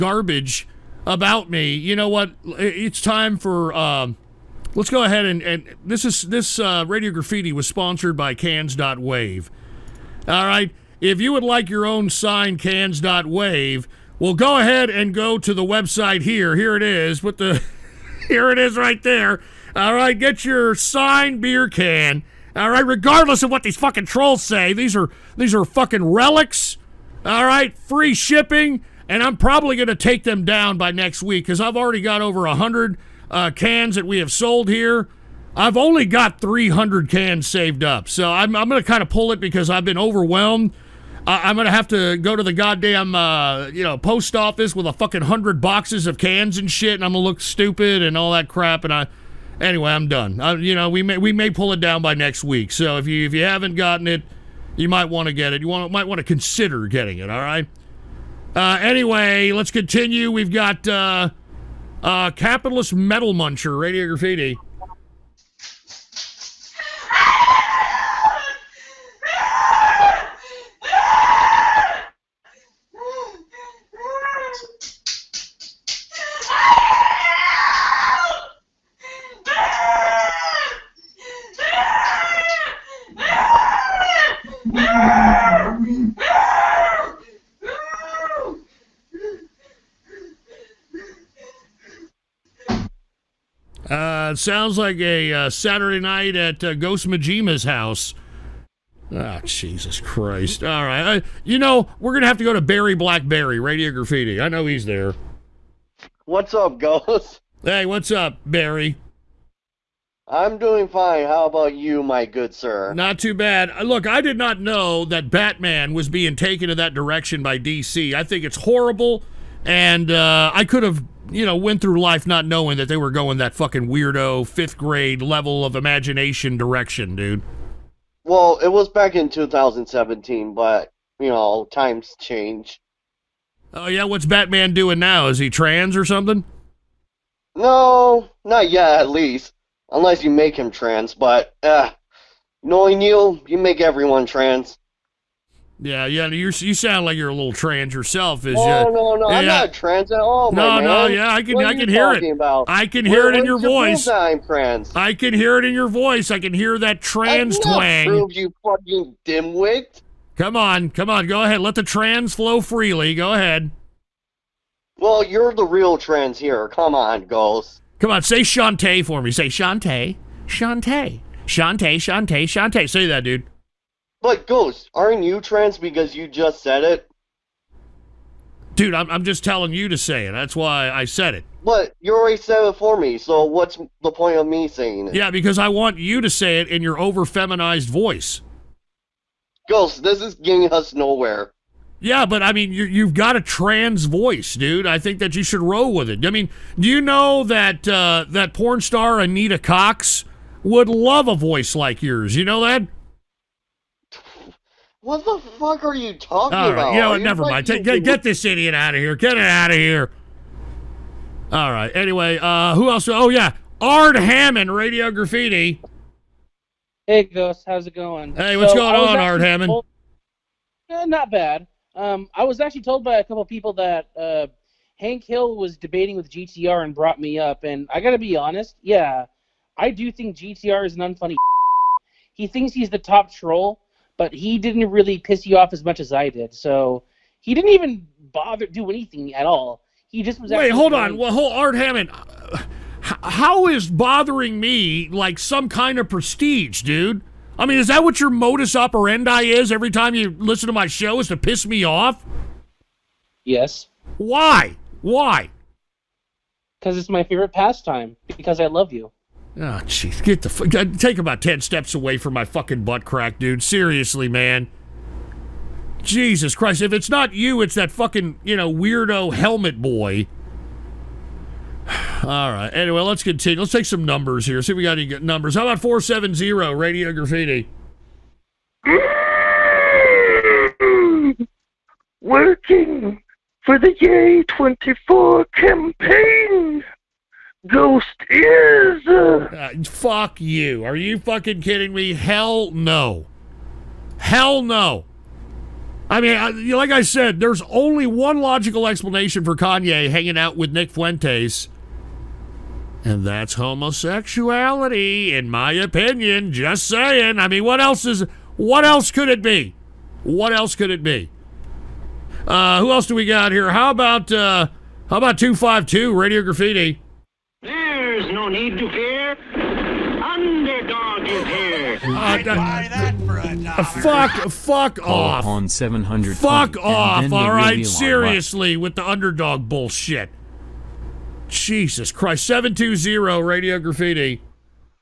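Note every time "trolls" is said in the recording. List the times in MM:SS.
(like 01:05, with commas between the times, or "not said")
00:24, 03:53.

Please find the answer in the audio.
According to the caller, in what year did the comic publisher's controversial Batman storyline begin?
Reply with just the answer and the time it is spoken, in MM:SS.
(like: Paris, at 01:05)
2017, at 02:09.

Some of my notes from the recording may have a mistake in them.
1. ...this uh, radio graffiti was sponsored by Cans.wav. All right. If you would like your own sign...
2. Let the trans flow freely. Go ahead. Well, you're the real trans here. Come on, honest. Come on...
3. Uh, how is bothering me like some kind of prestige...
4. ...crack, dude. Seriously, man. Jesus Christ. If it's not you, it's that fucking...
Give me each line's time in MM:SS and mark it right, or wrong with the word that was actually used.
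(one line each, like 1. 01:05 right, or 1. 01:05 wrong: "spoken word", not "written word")
1. 00:06 right
2. 02:41 wrong: "ghost", not "honest"
3. 04:02 right
4. 04:23 right.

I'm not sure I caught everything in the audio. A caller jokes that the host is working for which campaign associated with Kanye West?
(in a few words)
Ye 24.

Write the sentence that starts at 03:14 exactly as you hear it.
I think that you should roll with it.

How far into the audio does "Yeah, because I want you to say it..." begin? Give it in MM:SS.
03:05.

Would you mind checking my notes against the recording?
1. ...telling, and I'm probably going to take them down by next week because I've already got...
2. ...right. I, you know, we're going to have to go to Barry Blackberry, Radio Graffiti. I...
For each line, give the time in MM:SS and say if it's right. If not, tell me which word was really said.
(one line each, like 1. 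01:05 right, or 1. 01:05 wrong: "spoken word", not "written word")
1. 00:28 wrong: "shipping", not "telling"
2. 01:40 right.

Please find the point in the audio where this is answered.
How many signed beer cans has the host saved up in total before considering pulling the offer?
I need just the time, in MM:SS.
00:36.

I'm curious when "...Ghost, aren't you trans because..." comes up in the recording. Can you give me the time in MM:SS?
02:54.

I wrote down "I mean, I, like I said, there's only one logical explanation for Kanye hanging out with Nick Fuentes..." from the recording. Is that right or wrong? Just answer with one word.
right.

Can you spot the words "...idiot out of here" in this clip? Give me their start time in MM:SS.
03:28.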